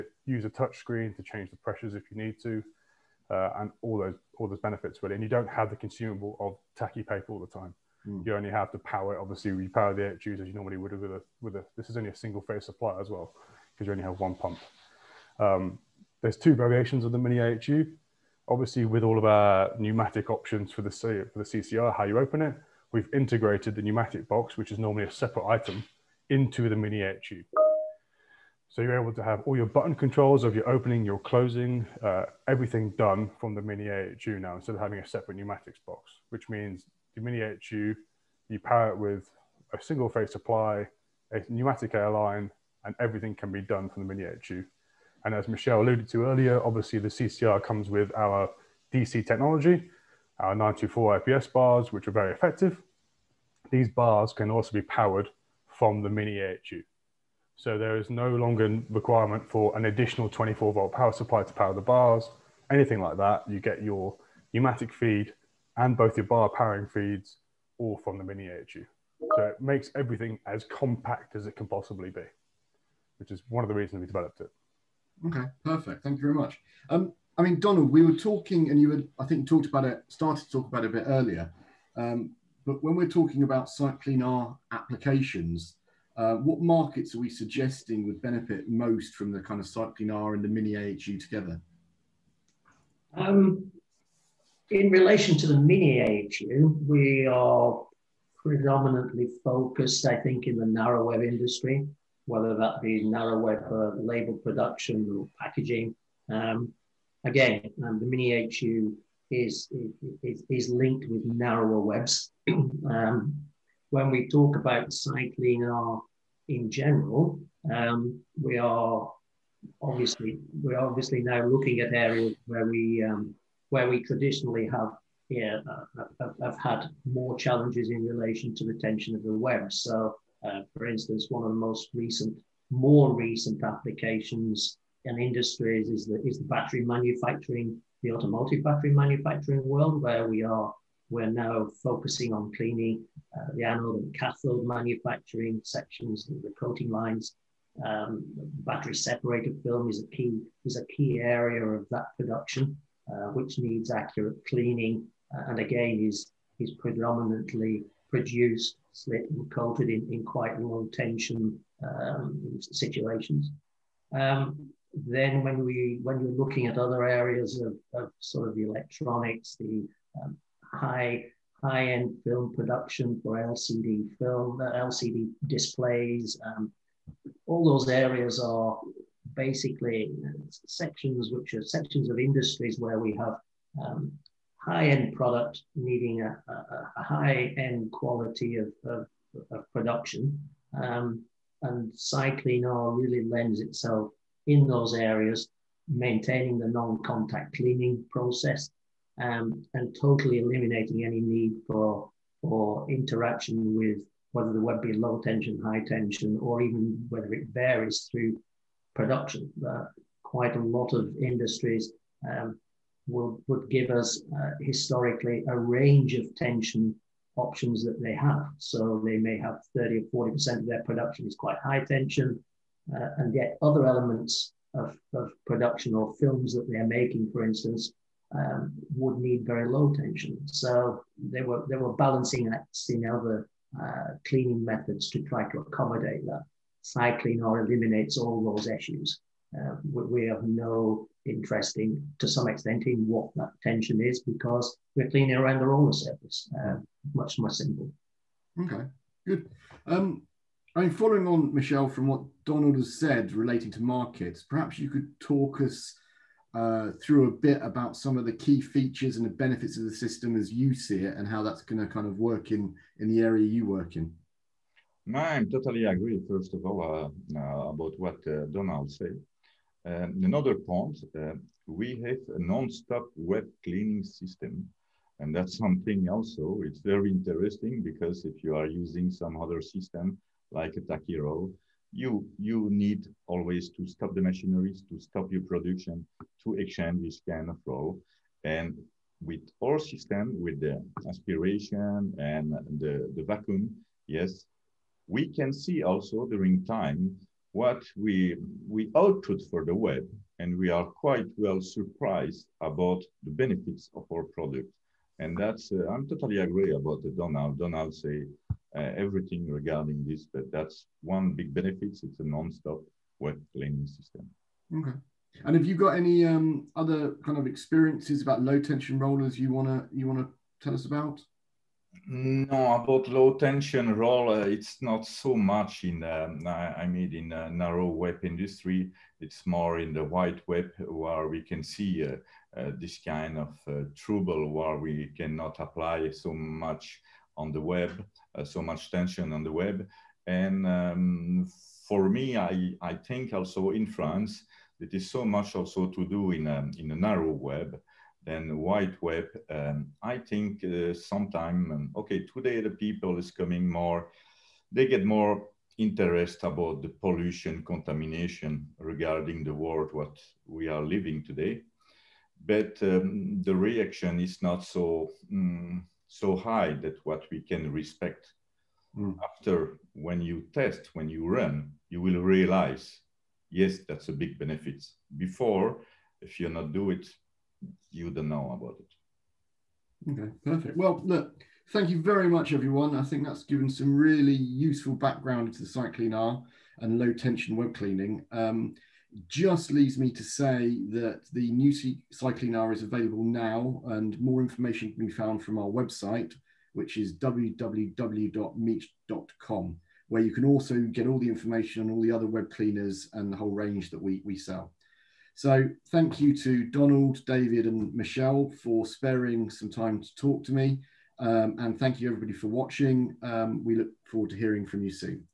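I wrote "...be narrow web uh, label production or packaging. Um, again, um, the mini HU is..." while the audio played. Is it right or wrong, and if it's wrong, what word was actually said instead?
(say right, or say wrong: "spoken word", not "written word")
right.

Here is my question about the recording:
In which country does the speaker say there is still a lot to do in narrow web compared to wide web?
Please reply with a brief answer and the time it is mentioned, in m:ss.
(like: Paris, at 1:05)
France, at 5:43.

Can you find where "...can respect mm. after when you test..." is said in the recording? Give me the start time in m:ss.
6:07.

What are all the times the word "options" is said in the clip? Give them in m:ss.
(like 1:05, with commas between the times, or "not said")
0:20, 3:37.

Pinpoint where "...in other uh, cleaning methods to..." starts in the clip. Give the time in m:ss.
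3:52.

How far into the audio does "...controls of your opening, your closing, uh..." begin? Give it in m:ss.
0:29.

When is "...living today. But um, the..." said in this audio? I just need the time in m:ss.
6:00.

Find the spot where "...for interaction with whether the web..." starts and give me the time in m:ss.
3:22.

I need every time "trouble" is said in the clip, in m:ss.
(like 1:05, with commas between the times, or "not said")
5:33.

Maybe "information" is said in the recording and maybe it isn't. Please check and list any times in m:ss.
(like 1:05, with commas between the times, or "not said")
6:34, 6:41.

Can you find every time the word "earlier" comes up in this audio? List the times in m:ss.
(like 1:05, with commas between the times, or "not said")
0:46, 1:21.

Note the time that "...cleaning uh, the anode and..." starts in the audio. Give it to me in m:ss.
2:22.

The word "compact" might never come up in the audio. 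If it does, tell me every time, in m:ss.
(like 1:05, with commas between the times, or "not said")
1:10.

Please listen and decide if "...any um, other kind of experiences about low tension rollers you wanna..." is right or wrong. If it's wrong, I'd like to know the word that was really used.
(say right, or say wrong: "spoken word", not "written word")
right.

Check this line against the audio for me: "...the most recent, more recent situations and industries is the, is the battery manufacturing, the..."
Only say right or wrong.
wrong.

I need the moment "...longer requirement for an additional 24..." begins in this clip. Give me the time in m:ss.
0:58.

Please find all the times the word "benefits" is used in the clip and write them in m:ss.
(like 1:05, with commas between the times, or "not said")
0:04, 1:28, 4:19, 5:03, 5:11, 6:14.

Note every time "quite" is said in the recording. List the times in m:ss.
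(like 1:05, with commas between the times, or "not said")
2:40, 3:30, 3:41, 5:00.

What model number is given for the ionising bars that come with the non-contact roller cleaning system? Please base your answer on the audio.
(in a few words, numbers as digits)
94.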